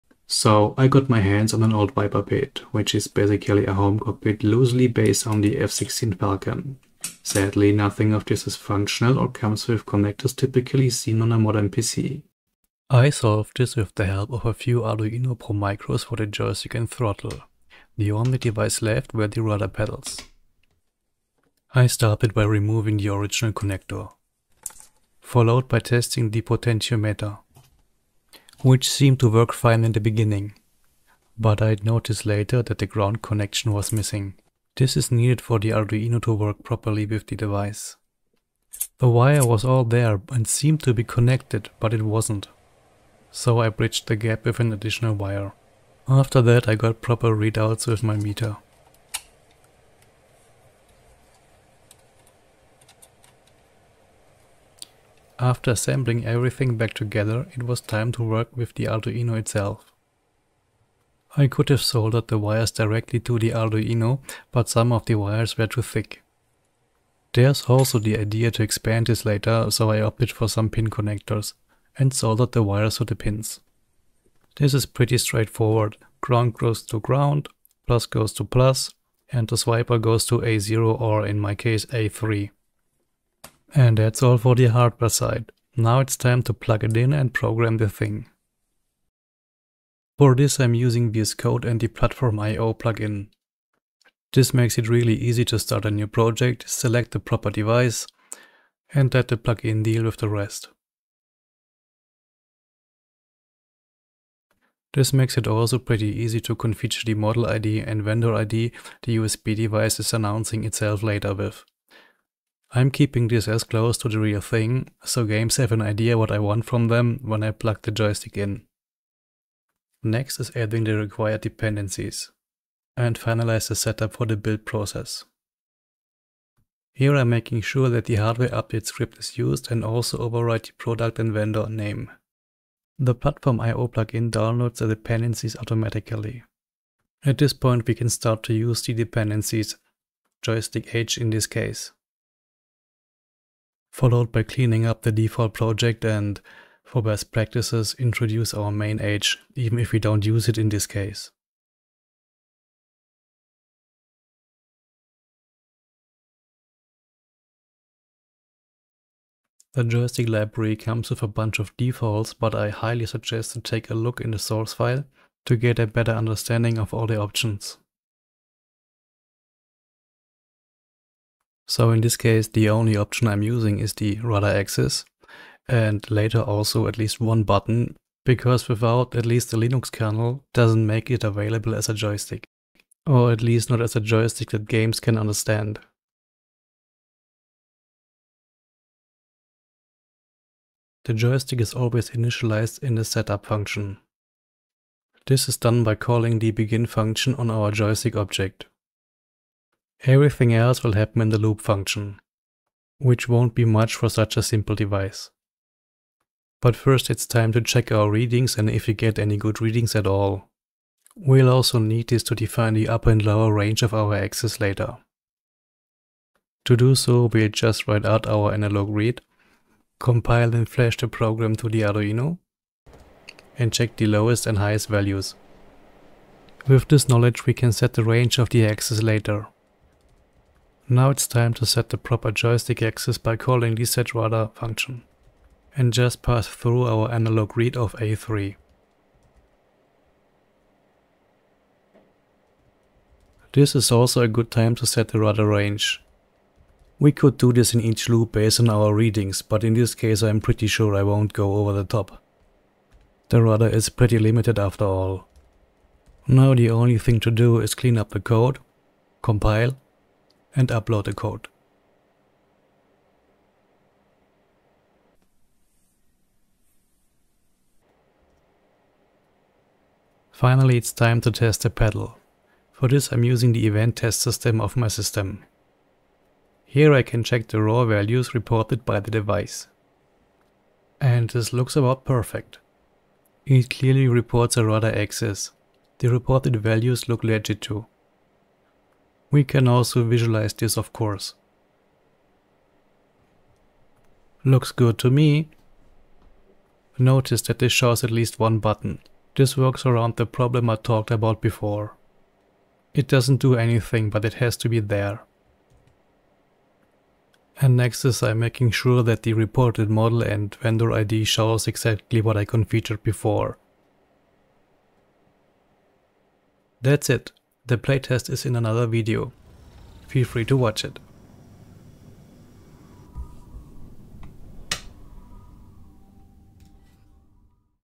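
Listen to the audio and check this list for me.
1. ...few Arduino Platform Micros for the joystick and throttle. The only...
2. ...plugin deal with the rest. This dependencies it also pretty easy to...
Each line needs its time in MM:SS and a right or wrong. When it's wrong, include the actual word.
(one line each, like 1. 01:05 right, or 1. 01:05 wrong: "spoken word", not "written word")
1. 00:14 wrong: "Pro", not "Platform"
2. 01:39 wrong: "makes", not "dependencies".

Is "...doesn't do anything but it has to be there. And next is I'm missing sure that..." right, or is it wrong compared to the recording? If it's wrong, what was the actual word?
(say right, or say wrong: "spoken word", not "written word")
wrong: "making", not "missing".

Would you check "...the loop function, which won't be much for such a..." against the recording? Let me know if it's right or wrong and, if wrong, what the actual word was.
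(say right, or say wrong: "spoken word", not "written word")
right.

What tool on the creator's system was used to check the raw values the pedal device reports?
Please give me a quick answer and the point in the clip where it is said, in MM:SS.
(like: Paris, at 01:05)
evtest, at 04:33.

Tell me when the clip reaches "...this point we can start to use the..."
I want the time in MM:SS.
02:17.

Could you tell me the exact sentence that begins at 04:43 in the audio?
It clearly reports a rudder axis.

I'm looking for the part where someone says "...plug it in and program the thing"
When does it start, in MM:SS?
01:26.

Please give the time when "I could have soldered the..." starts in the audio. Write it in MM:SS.
01:01.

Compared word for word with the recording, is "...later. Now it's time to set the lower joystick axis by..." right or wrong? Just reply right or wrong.
wrong.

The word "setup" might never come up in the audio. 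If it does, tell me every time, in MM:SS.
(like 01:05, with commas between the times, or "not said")
02:03, 03:13.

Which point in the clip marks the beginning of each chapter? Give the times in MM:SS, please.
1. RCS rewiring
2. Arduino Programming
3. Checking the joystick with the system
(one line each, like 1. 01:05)
1. 00:20
2. 01:29
3. 04:28.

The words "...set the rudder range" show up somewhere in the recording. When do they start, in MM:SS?
04:04.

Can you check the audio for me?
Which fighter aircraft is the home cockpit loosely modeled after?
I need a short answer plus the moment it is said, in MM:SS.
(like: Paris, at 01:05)
F-16 Falcon, at 00:05.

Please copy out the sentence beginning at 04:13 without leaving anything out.
The rudder is pretty limited after all.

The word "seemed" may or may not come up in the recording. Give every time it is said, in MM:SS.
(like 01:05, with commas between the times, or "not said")
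00:28, 00:40.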